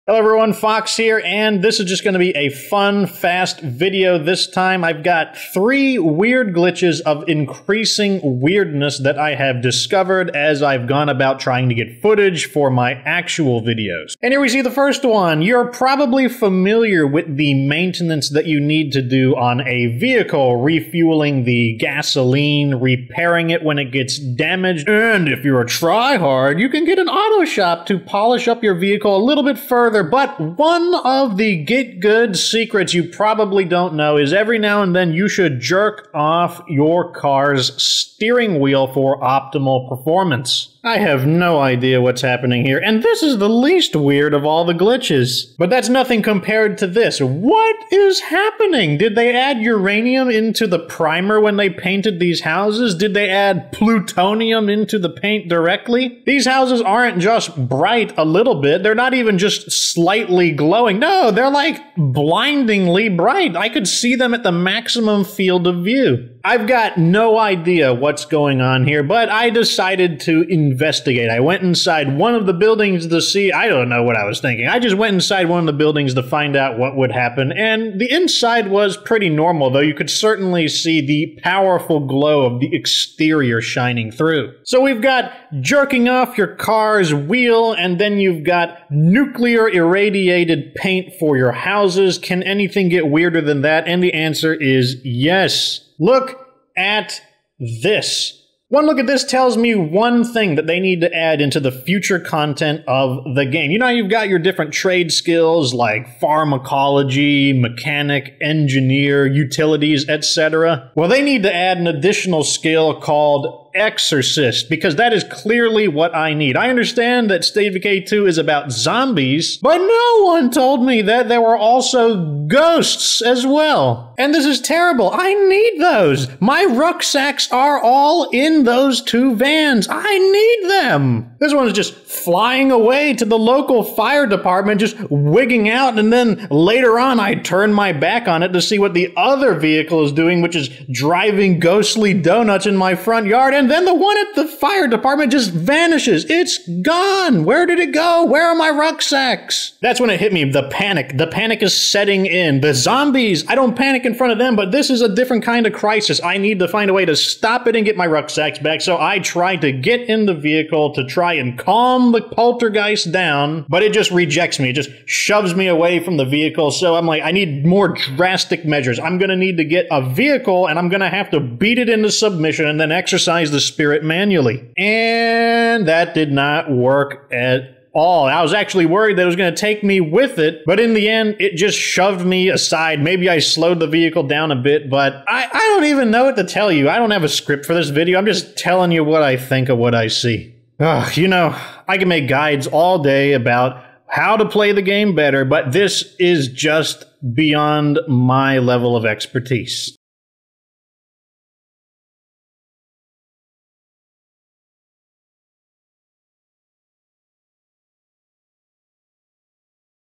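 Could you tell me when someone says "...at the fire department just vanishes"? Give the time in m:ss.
2:24.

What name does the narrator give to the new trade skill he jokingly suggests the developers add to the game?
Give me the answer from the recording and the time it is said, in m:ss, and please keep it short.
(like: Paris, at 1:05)
Exorcist, at 1:53.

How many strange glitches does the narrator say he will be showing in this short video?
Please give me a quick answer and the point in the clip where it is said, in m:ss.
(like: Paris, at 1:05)
3, at 0:05.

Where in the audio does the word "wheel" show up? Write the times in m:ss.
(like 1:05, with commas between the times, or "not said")
0:38, 1:27.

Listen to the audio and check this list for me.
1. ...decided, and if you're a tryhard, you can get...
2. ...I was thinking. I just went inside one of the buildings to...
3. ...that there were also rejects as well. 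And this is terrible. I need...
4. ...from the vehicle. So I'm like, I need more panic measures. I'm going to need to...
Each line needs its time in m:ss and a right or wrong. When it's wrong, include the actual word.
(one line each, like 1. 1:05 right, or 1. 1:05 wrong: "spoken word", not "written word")
1. 0:24 wrong: "damaged", not "decided"
2. 1:14 right
3. 2:01 wrong: "ghosts", not "rejects"
4. 2:46 wrong: "drastic", not "panic".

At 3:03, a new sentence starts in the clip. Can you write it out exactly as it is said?
Maybe I slowed the vehicle down a bit, but I, I don't even know what to tell you.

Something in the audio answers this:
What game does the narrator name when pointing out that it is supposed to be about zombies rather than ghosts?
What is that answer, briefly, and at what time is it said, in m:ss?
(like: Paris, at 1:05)
State of Decay 2, at 1:57.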